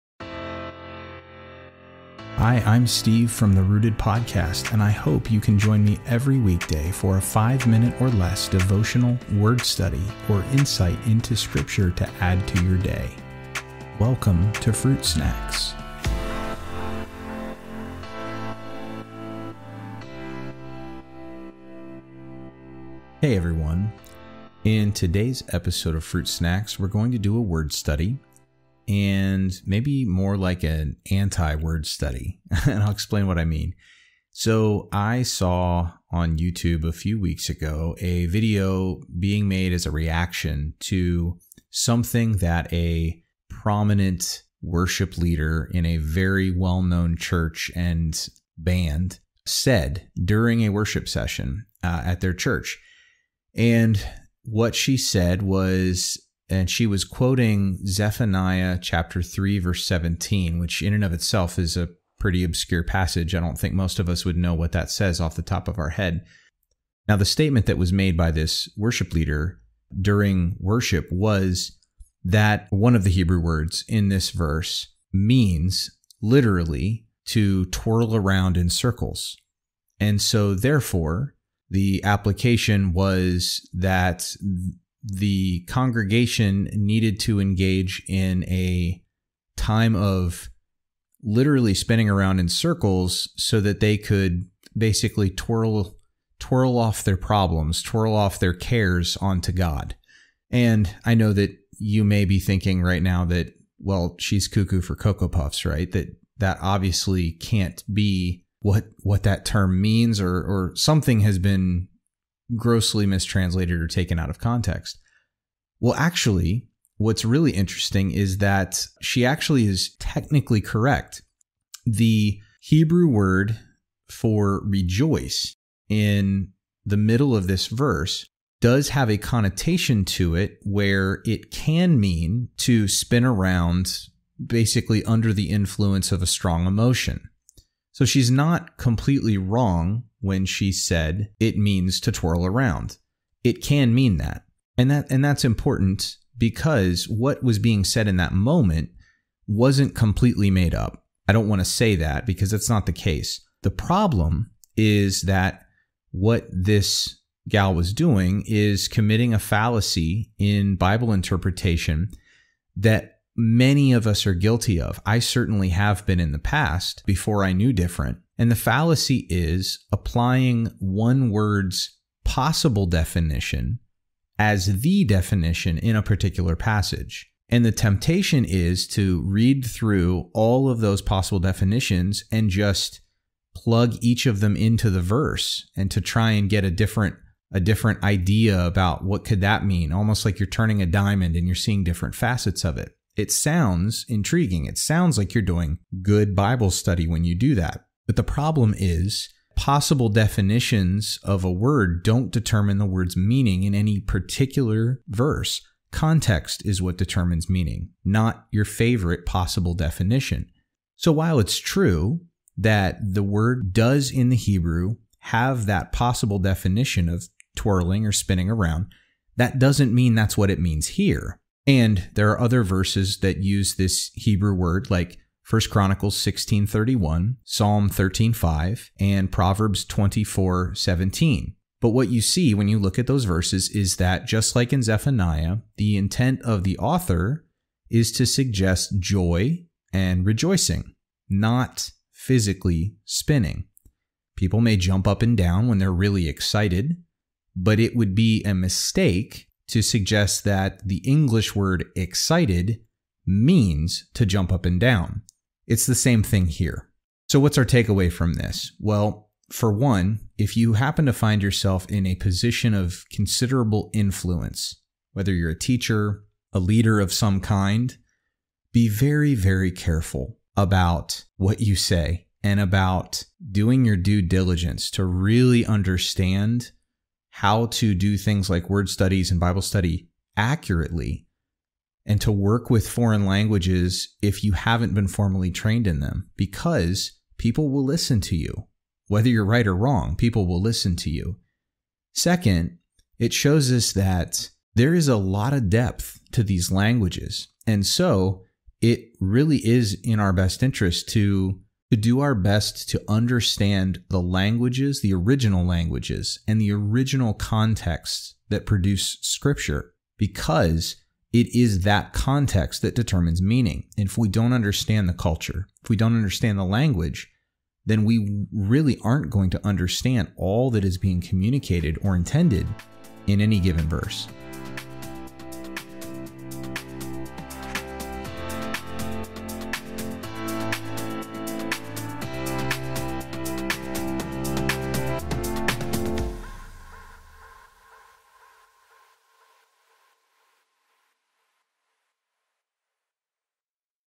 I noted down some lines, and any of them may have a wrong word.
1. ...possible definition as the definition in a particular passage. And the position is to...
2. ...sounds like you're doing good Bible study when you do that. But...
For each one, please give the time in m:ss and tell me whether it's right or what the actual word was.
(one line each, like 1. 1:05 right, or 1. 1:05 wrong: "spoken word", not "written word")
1. 2:52 wrong: "temptation", not "position"
2. 3:14 right.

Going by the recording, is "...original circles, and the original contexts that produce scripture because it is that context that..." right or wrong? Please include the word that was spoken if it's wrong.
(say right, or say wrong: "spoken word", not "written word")
wrong: "languages", not "circles".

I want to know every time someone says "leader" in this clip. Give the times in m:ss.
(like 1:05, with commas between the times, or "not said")
0:45, 1:09, 4:26.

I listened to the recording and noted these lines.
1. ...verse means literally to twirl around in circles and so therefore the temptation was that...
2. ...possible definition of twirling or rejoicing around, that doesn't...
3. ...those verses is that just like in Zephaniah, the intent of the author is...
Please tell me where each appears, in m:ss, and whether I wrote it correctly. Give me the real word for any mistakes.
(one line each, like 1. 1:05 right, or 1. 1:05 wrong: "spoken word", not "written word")
1. 1:14 wrong: "application", not "temptation"
2. 3:35 wrong: "spinning", not "rejoicing"
3. 3:53 right.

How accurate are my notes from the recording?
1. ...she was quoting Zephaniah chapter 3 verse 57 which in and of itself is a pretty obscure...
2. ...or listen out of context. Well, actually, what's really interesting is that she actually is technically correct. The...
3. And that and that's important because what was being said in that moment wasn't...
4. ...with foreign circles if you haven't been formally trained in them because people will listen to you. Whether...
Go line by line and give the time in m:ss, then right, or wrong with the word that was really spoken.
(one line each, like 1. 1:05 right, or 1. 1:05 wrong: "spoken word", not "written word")
1. 0:56 wrong: "17", not "57"
2. 1:53 wrong: "taken", not "listen"
3. 2:24 right
4. 4:42 wrong: "languages", not "circles".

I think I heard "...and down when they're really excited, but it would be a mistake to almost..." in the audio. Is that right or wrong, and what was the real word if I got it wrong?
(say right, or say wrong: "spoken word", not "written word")
wrong: "suggest", not "almost".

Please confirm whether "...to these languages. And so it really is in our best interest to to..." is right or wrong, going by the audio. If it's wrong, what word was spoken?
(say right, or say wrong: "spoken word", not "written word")
right.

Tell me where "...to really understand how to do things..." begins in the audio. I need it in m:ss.
4:34.